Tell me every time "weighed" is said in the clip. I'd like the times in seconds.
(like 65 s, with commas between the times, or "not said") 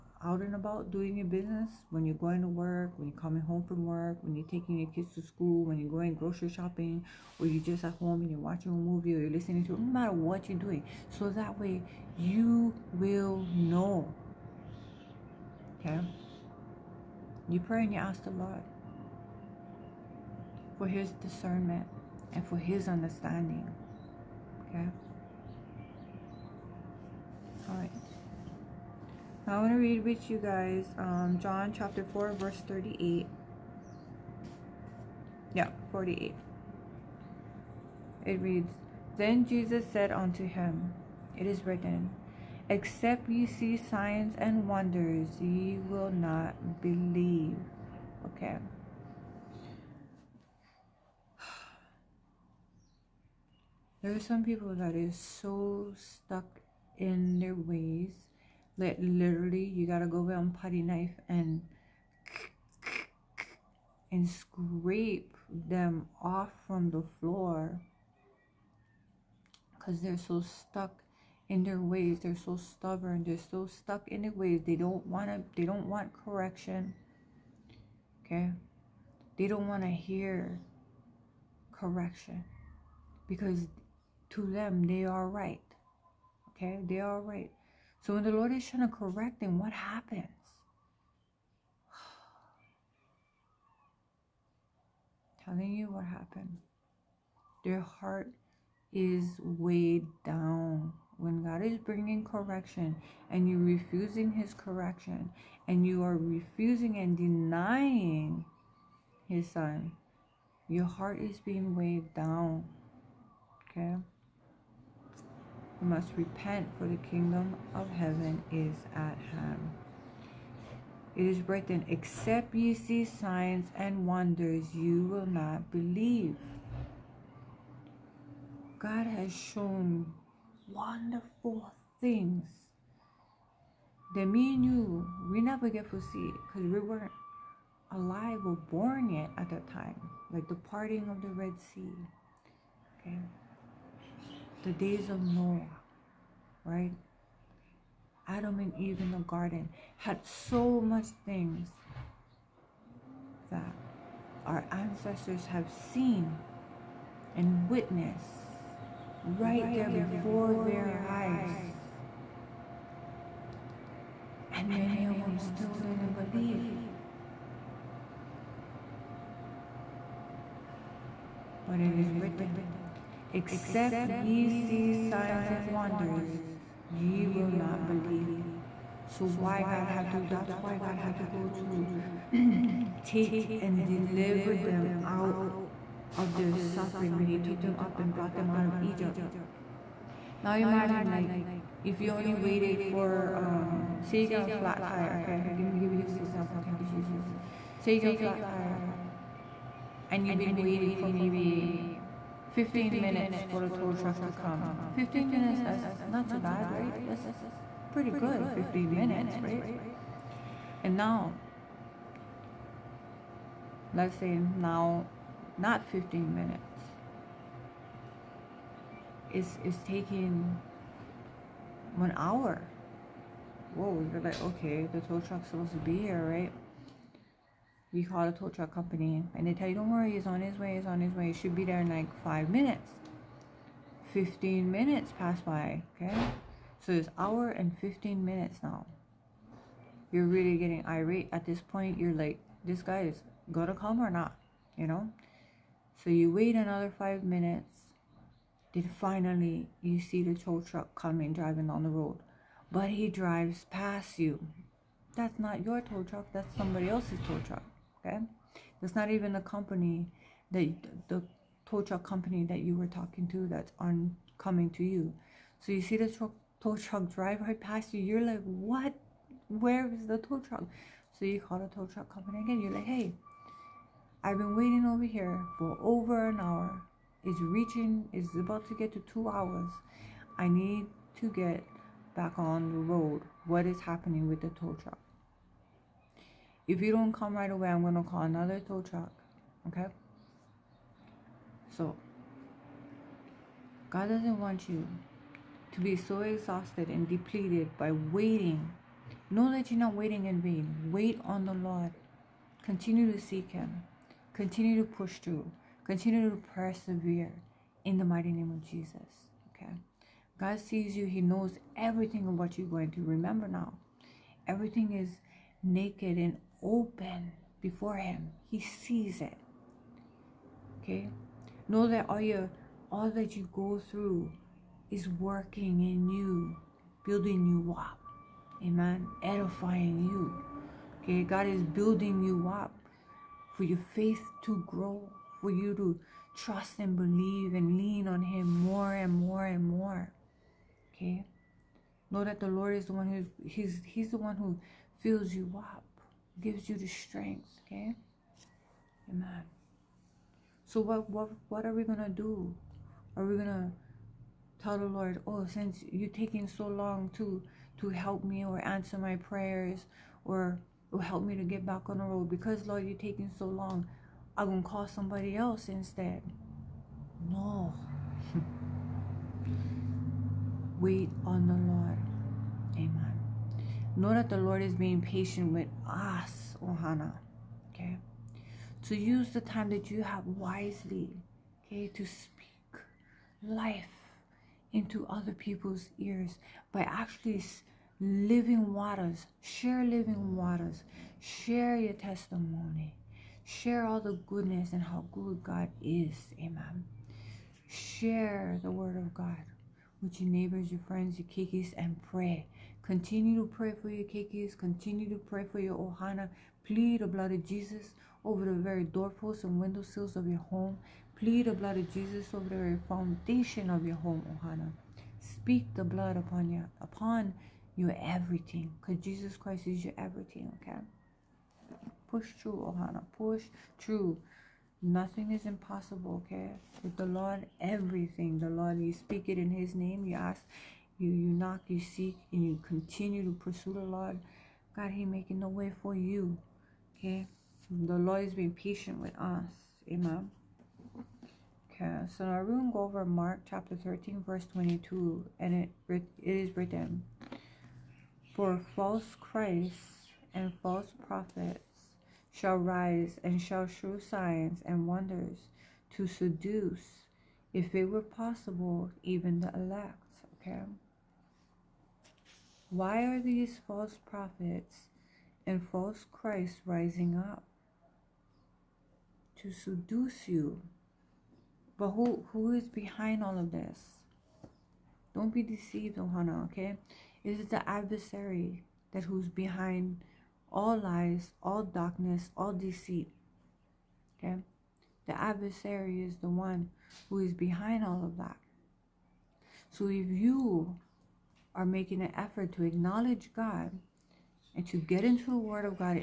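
99 s, 111 s.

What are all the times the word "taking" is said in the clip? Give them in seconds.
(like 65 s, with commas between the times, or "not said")
4 s, 219 s, 356 s, 362 s.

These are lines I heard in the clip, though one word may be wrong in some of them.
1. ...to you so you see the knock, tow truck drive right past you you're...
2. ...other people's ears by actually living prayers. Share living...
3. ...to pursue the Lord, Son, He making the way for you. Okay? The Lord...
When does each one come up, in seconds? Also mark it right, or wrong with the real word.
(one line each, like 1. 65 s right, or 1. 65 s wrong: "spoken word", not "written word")
1. 264 s wrong: "truck", not "knock"
2. 385 s wrong: "waters", not "prayers"
3. 433 s wrong: "God", not "Son".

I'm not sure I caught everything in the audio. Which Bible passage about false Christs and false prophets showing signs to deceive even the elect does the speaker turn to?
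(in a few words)
Mark 13:22.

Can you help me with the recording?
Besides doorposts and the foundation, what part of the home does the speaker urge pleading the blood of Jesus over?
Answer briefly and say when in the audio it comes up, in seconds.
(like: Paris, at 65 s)
windowsills, at 409 s.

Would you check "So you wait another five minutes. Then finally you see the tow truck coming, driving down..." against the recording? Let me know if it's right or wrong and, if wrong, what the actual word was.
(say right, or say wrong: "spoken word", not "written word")
right.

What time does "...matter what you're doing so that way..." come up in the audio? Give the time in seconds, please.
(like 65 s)
9 s.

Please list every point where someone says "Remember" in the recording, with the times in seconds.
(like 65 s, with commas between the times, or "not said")
313 s.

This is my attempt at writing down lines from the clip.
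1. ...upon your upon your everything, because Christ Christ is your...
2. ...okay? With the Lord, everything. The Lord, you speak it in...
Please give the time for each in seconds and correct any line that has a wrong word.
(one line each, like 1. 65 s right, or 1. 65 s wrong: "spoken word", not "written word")
1. 416 s wrong: "Jesus", not "Christ"
2. 426 s right.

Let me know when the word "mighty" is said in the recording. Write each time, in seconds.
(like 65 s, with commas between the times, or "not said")
308 s.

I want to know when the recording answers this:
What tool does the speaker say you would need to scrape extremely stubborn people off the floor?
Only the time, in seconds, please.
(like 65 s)
60 s.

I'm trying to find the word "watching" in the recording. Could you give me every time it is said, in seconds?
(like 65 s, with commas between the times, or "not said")
8 s.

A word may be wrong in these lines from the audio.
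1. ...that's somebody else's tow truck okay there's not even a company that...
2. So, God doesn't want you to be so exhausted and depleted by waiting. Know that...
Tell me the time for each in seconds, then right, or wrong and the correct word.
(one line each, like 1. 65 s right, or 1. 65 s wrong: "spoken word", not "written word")
1. 256 s right
2. 291 s right.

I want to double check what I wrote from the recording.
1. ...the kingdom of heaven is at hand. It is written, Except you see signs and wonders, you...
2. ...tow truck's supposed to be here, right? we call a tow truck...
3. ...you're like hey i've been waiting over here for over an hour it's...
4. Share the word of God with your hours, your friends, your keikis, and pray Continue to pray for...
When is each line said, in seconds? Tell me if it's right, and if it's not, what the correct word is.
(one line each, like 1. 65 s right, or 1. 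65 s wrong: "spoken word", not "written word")
1. 116 s right
2. 225 s right
3. 272 s right
4. 397 s wrong: "neighbors", not "hours".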